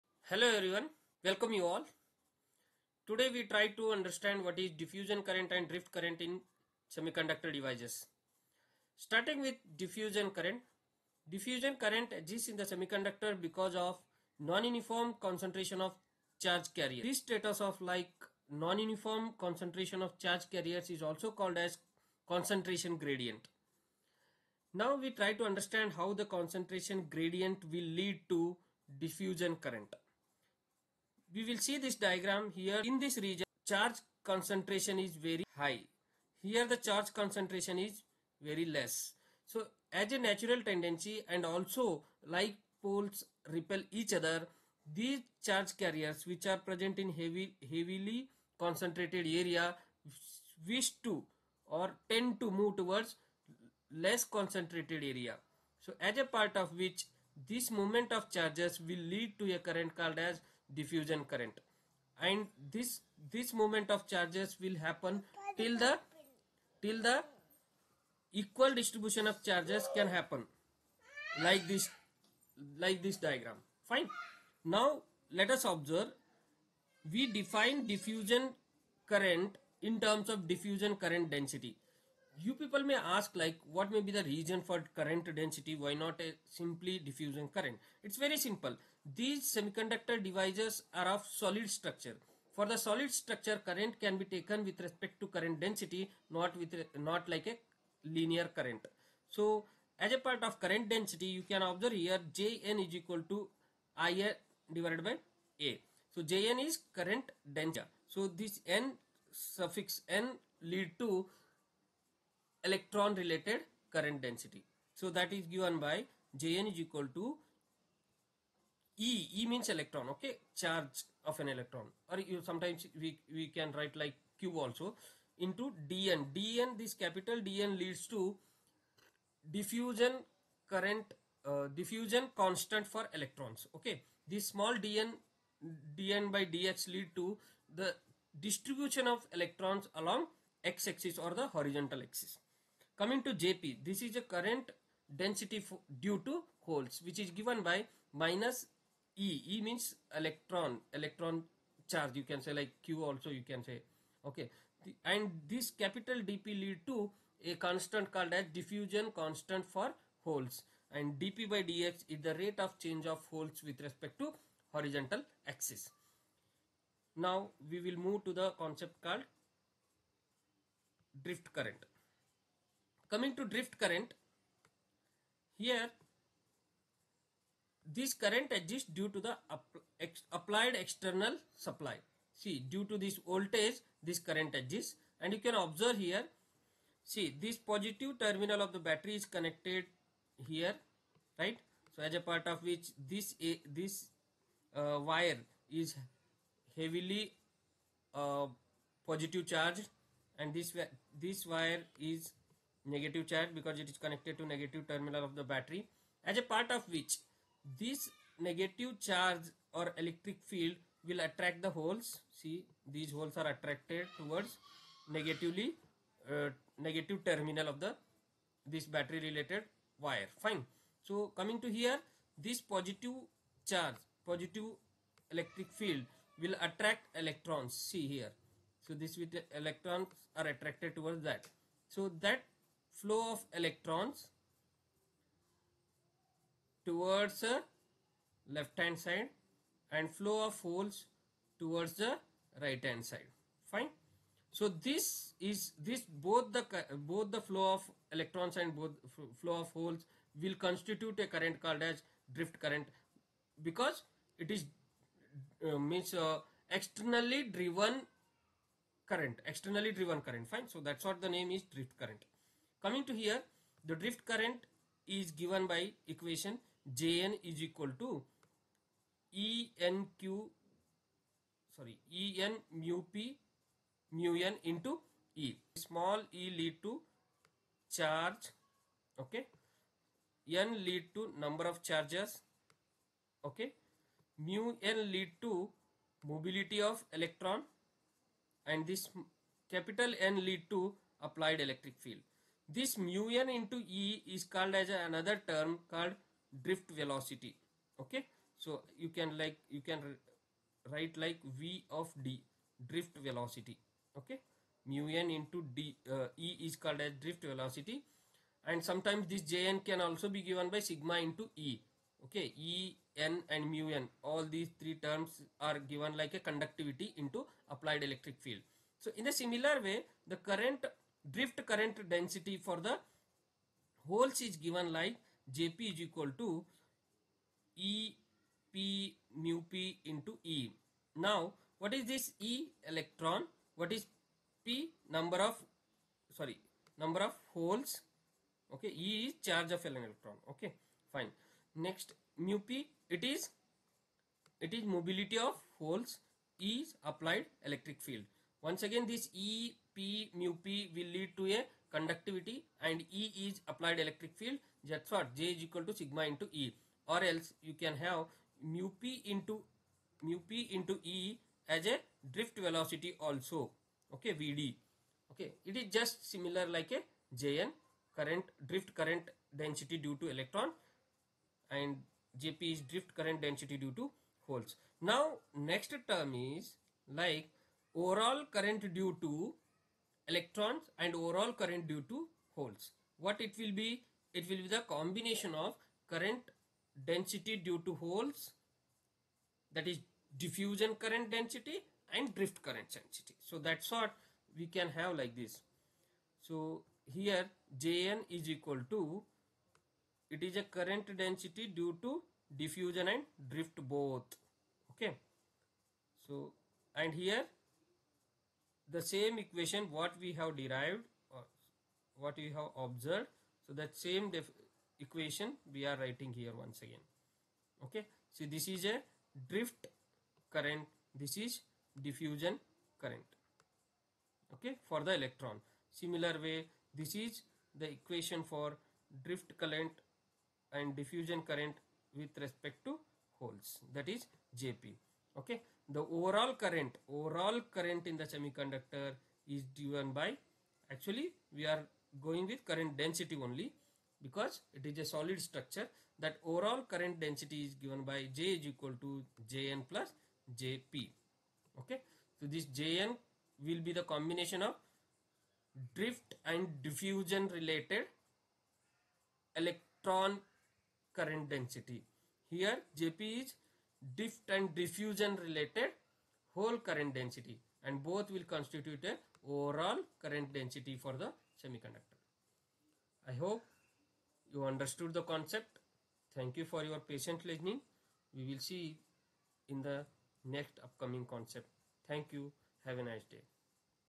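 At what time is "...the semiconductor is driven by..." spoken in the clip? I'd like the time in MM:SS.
07:18.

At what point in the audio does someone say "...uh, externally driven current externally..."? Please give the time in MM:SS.
04:16.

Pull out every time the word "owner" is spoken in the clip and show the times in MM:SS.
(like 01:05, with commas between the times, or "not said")
not said.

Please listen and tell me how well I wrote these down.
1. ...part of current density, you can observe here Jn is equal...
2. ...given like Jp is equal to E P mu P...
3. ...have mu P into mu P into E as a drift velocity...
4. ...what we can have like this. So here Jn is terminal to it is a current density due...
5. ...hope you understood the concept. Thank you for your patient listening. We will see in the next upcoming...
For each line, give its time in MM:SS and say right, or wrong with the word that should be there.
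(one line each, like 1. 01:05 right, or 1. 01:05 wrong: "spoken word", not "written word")
1. 01:40 right
2. 05:24 right
3. 05:57 right
4. 06:33 wrong: "equal", not "terminal"
5. 07:53 right.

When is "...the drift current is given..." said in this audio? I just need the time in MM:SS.
04:23.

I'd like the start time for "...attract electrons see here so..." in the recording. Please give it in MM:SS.
03:46.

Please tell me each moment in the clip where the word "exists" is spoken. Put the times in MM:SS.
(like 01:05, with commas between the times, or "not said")
00:12, 02:58, 03:04.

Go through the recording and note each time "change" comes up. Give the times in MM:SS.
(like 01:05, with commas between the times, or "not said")
02:42.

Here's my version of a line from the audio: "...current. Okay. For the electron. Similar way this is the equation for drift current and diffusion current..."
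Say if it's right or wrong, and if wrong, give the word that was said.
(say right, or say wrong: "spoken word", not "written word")
right.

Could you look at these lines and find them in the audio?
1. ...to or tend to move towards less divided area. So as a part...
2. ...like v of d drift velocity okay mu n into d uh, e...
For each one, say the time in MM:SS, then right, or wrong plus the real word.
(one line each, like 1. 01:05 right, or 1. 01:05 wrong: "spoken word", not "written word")
1. 00:51 wrong: "concentrated", not "divided"
2. 05:01 right.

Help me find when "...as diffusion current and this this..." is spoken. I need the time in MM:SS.
01:00.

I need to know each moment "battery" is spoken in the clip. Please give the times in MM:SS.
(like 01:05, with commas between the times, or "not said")
03:08, 03:25, 03:38.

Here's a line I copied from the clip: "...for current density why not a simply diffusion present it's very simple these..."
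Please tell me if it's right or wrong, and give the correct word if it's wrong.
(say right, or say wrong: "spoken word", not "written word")
wrong: "current", not "present".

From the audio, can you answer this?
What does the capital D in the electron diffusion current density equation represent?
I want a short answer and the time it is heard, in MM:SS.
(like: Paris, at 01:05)
Diffusion constant for electrons, at 02:11.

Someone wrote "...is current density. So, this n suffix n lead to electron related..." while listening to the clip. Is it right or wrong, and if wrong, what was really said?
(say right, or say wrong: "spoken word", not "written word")
right.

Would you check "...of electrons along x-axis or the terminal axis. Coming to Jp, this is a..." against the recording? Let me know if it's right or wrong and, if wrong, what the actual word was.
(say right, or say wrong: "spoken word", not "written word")
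wrong: "horizontal", not "terminal".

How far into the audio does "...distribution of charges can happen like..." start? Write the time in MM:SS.
01:08.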